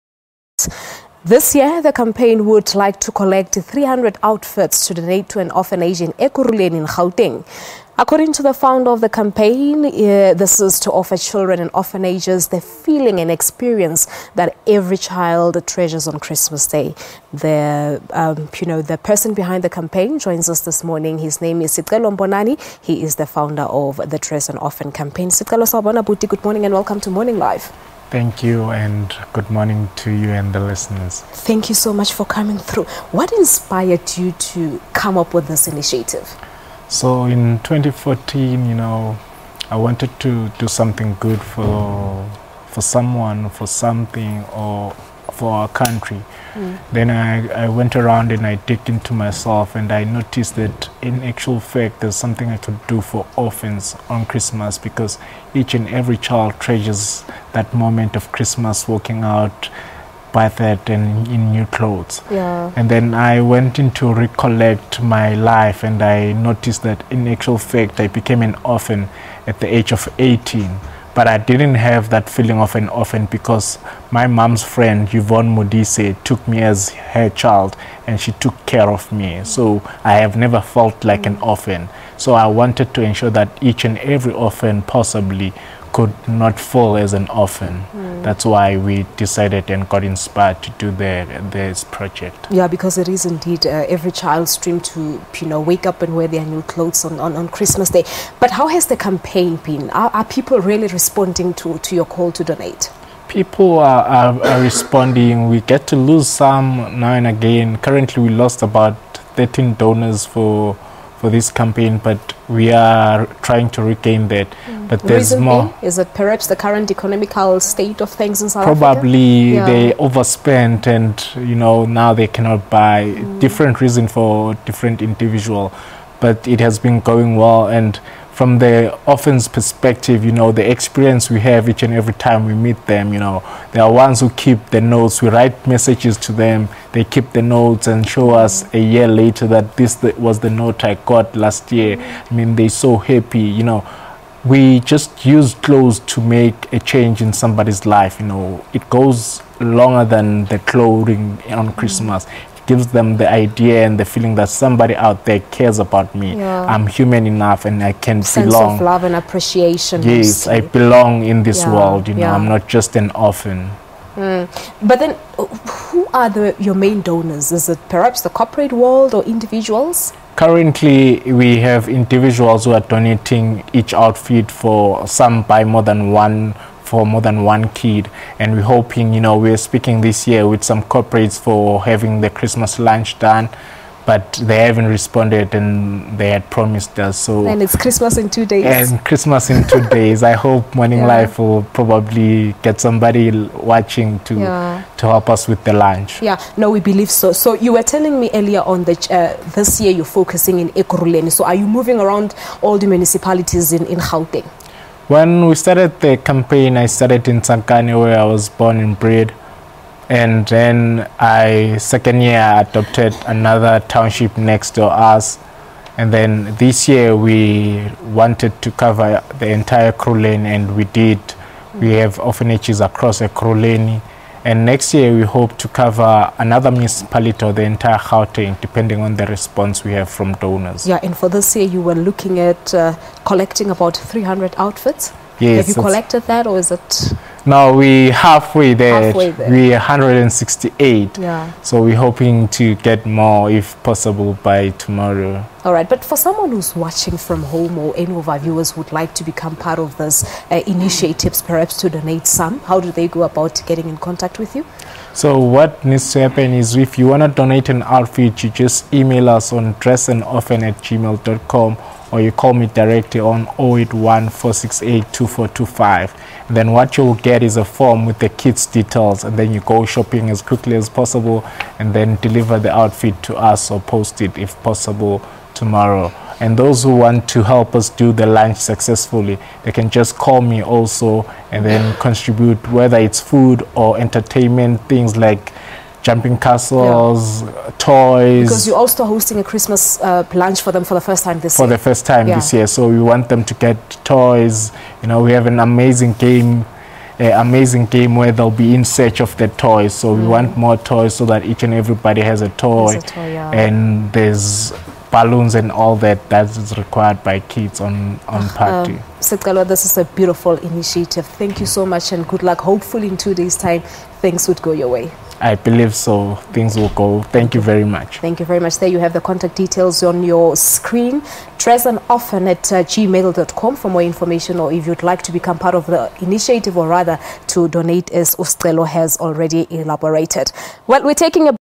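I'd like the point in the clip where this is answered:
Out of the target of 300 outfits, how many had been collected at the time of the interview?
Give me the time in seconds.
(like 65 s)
239 s.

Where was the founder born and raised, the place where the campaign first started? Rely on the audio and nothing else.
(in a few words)
Sankani.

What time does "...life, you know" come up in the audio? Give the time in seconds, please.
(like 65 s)
147 s.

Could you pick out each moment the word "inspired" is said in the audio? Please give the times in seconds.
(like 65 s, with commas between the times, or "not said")
33 s, 90 s.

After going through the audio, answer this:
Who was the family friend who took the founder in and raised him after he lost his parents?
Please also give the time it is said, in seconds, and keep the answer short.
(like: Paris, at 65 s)
Yvonne Modise, at 75 s.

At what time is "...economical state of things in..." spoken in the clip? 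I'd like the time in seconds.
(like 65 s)
116 s.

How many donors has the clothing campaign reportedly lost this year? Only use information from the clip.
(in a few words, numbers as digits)
13.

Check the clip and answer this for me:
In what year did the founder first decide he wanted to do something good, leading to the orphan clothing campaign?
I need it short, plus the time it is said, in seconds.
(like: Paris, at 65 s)
2014, at 37 s.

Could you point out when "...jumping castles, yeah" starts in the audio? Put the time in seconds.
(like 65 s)
286 s.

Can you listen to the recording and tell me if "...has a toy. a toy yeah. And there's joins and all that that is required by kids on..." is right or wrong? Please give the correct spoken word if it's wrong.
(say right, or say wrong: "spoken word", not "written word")
wrong: "balloons", not "joins".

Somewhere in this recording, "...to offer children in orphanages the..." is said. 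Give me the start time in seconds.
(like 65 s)
10 s.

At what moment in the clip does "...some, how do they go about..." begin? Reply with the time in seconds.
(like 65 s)
252 s.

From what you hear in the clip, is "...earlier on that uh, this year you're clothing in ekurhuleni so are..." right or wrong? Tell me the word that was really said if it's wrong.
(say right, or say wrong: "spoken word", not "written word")
wrong: "focusing", not "clothing".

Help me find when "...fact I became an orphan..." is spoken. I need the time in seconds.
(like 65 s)
67 s.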